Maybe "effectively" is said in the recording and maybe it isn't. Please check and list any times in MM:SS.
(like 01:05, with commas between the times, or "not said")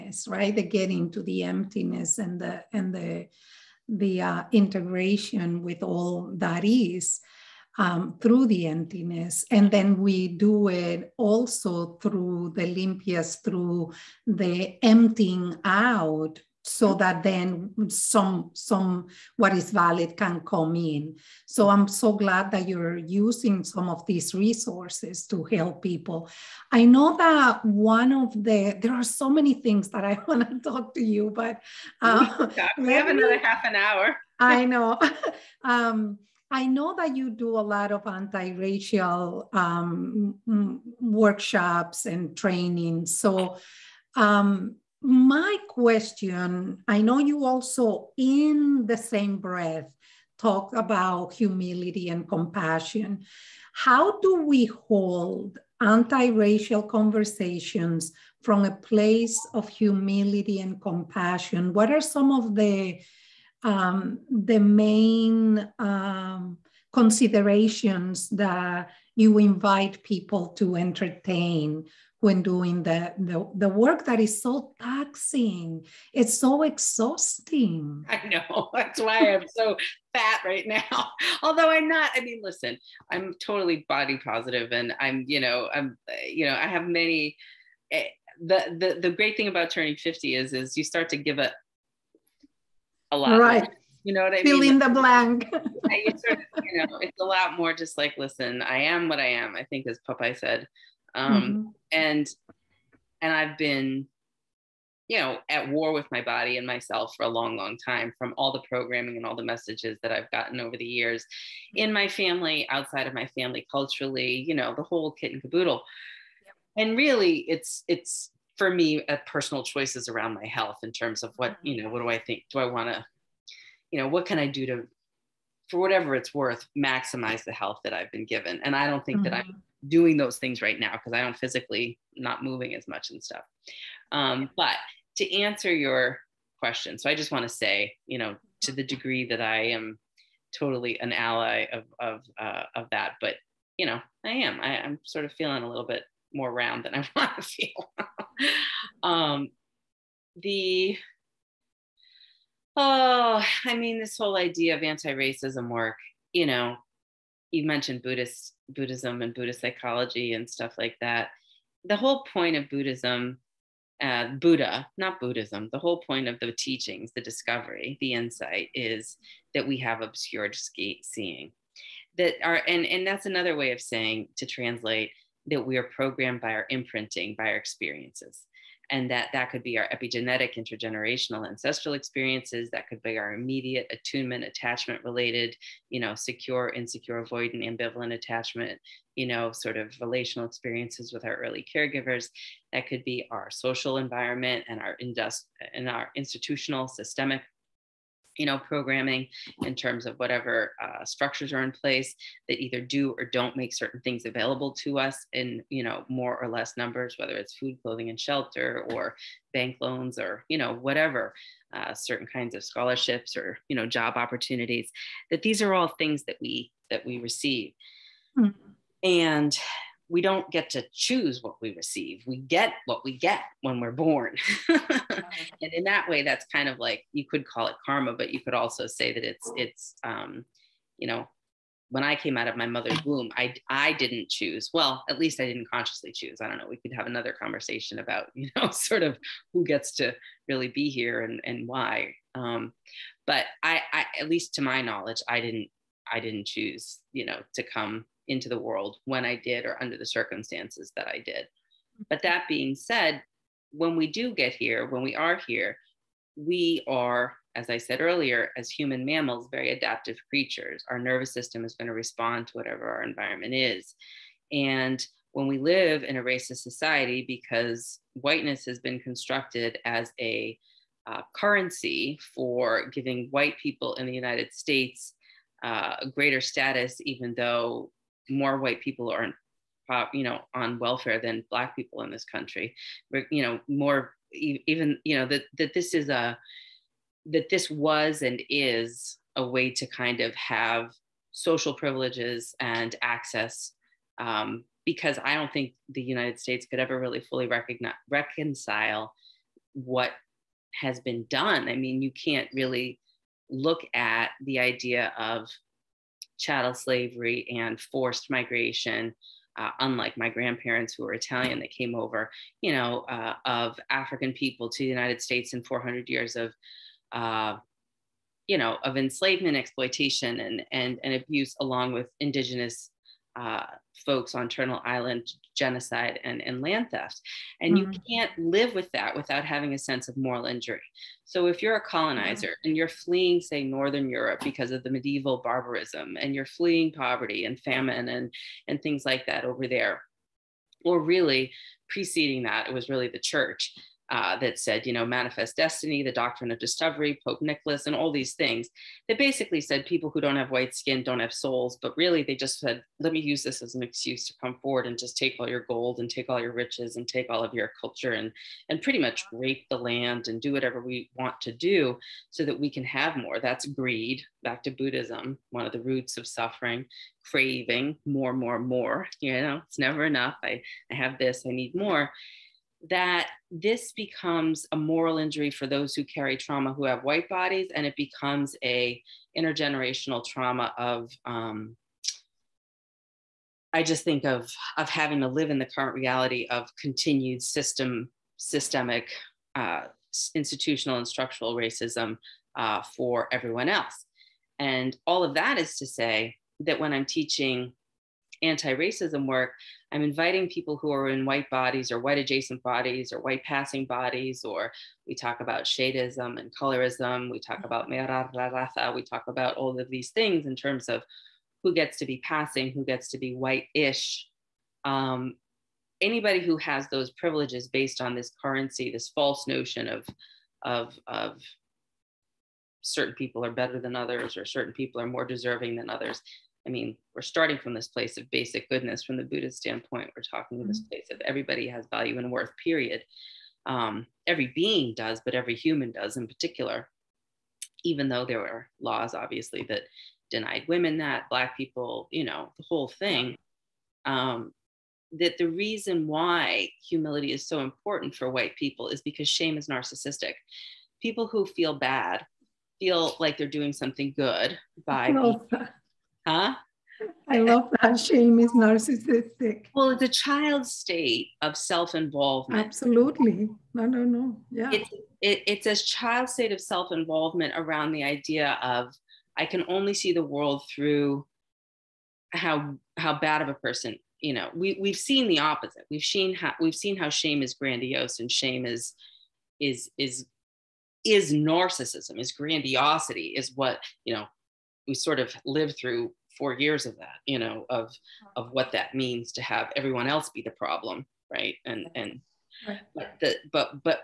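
not said.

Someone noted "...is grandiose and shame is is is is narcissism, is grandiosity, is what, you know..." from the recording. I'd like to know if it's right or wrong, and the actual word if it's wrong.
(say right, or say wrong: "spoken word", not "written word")
right.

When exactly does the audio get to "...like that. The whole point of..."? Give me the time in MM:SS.
02:40.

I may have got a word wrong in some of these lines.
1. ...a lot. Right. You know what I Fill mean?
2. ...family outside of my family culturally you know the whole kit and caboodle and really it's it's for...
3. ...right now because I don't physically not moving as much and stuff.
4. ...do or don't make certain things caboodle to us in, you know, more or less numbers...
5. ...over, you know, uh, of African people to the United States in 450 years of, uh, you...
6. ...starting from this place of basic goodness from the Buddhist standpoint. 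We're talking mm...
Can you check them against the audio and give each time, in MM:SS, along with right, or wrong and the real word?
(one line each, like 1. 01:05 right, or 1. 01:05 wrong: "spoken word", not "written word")
1. 01:33 right
2. 01:52 right
3. 02:10 right
4. 03:22 wrong: "available", not "caboodle"
5. 05:11 wrong: "400", not "450"
6. 07:07 right.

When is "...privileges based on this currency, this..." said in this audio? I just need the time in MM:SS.
06:57.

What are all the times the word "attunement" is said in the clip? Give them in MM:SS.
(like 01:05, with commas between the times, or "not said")
03:03.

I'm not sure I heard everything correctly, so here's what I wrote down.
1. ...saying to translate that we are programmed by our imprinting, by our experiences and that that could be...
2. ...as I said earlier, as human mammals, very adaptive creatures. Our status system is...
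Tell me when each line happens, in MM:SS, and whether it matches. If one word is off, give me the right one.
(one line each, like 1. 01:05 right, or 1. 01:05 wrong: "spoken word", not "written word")
1. 02:53 right
2. 04:17 wrong: "nervous", not "status".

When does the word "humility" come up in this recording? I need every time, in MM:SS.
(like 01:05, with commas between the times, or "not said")
00:51, 00:59, 07:26.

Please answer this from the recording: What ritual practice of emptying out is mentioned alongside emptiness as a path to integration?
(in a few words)
limpias.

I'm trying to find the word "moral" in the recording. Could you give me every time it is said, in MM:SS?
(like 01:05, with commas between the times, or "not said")
05:30, 06:14.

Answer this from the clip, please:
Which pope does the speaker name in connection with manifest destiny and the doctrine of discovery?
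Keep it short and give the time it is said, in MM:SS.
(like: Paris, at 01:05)
Pope Nicholas, at 05:47.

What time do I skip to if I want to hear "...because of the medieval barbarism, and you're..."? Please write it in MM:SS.
05:34.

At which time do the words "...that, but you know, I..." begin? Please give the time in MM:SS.
02:22.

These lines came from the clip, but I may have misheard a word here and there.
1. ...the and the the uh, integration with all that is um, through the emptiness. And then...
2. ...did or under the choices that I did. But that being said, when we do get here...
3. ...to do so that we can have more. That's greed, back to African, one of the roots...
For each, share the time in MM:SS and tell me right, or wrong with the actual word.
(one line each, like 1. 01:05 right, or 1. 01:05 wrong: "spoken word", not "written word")
1. 00:02 right
2. 04:09 wrong: "circumstances", not "choices"
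3. 06:01 wrong: "Buddhism", not "African".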